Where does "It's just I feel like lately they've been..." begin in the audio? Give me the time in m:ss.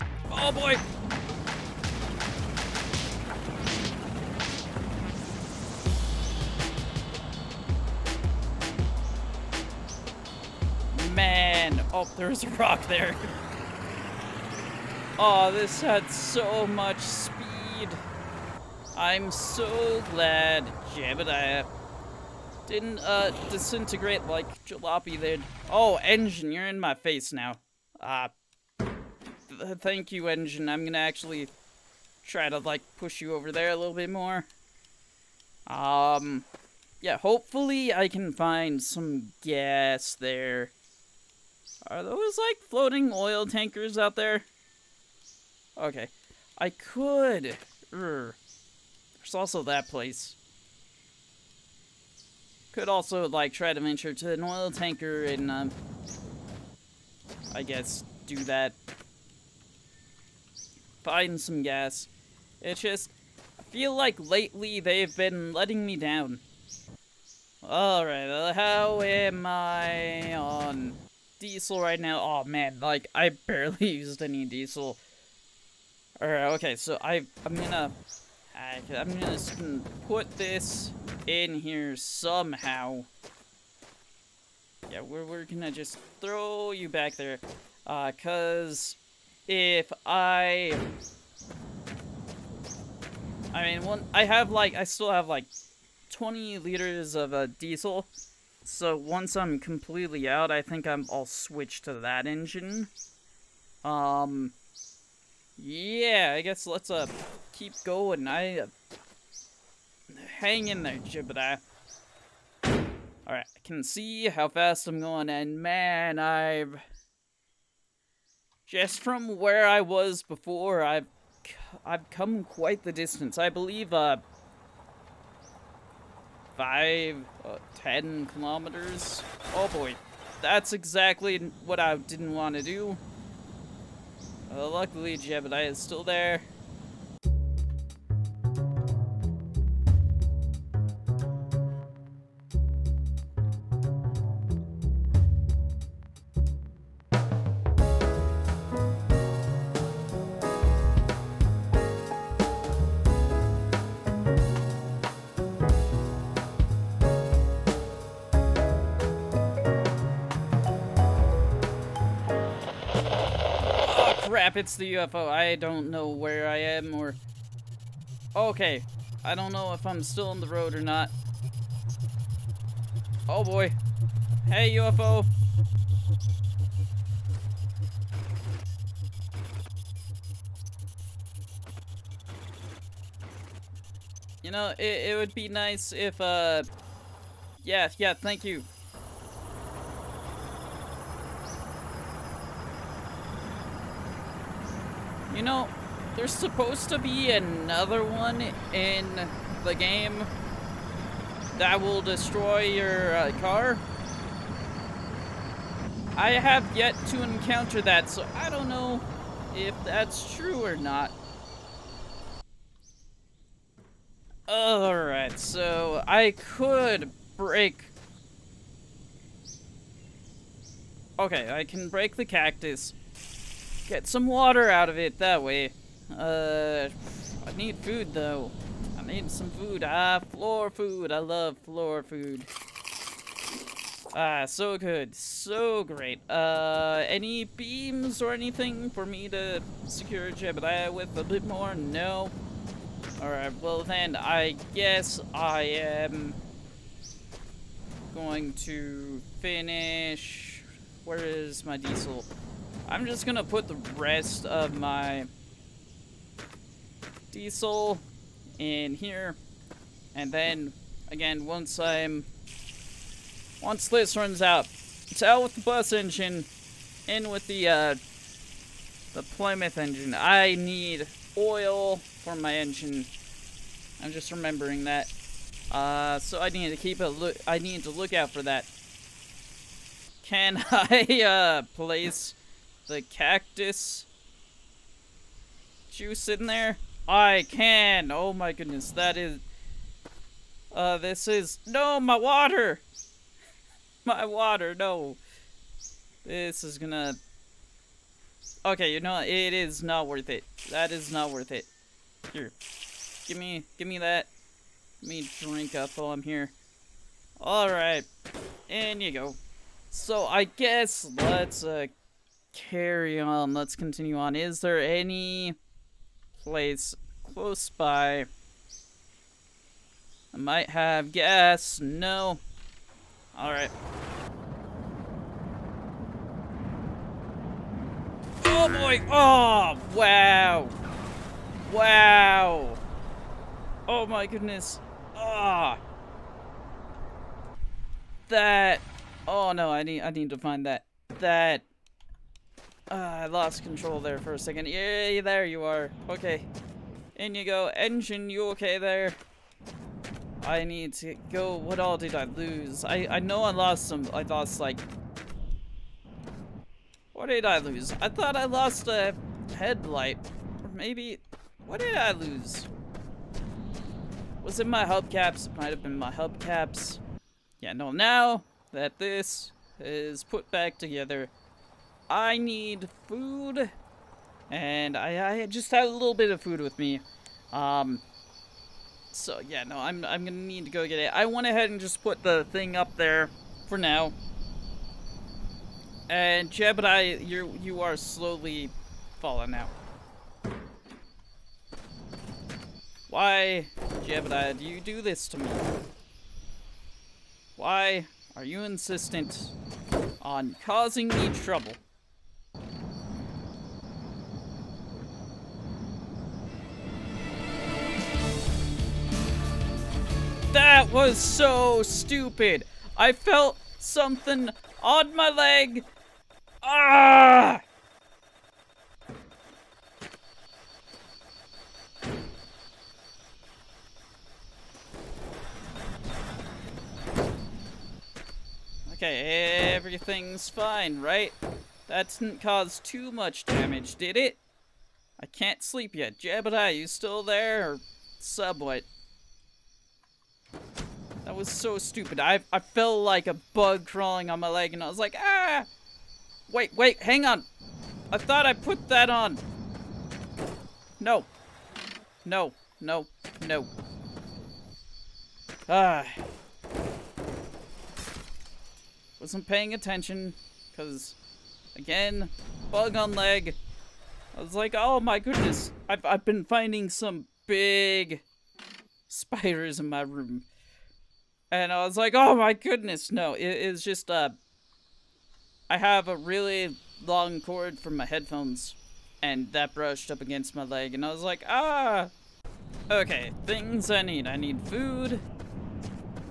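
1:02.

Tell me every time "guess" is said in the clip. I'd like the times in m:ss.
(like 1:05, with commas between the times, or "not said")
0:57, 1:46, 4:04, 5:10.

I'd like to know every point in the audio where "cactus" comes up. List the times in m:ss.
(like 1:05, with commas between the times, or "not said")
3:42, 4:43.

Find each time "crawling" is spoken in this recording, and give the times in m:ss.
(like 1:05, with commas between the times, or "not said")
7:23.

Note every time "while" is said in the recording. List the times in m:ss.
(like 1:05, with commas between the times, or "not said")
5:05.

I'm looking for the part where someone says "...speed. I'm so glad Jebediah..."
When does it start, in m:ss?
0:16.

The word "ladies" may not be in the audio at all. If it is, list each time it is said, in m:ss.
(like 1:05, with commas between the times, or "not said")
not said.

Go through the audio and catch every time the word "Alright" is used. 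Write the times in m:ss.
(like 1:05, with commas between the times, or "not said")
1:07, 1:16, 1:52, 3:34, 4:03, 5:07, 5:23.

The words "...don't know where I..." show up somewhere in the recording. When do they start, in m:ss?
2:45.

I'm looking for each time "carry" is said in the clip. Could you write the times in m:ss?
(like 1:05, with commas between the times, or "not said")
5:12.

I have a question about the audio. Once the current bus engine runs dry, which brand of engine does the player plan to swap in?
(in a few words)
Plymouth.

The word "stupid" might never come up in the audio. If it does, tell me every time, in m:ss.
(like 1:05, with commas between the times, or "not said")
6:51, 7:21.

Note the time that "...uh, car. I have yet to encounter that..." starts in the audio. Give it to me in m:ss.
3:23.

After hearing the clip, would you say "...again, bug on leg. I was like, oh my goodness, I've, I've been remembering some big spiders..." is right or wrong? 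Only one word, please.
wrong.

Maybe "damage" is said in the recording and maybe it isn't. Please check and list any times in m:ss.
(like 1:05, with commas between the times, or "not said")
7:13.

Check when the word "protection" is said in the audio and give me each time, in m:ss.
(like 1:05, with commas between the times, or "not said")
not said.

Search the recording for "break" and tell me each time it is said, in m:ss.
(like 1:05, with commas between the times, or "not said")
3:37, 3:41.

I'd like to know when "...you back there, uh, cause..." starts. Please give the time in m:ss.
1:26.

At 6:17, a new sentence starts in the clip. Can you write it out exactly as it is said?
Um, so yeah, no, I'm, I'm gonna need to go get it.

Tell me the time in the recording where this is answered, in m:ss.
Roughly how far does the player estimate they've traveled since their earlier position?
2:07.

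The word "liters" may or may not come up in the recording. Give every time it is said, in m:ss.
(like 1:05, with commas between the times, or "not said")
1:36.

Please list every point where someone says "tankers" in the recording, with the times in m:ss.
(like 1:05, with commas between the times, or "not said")
0:43, 0:54.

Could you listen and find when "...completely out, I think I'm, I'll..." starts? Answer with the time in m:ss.
1:39.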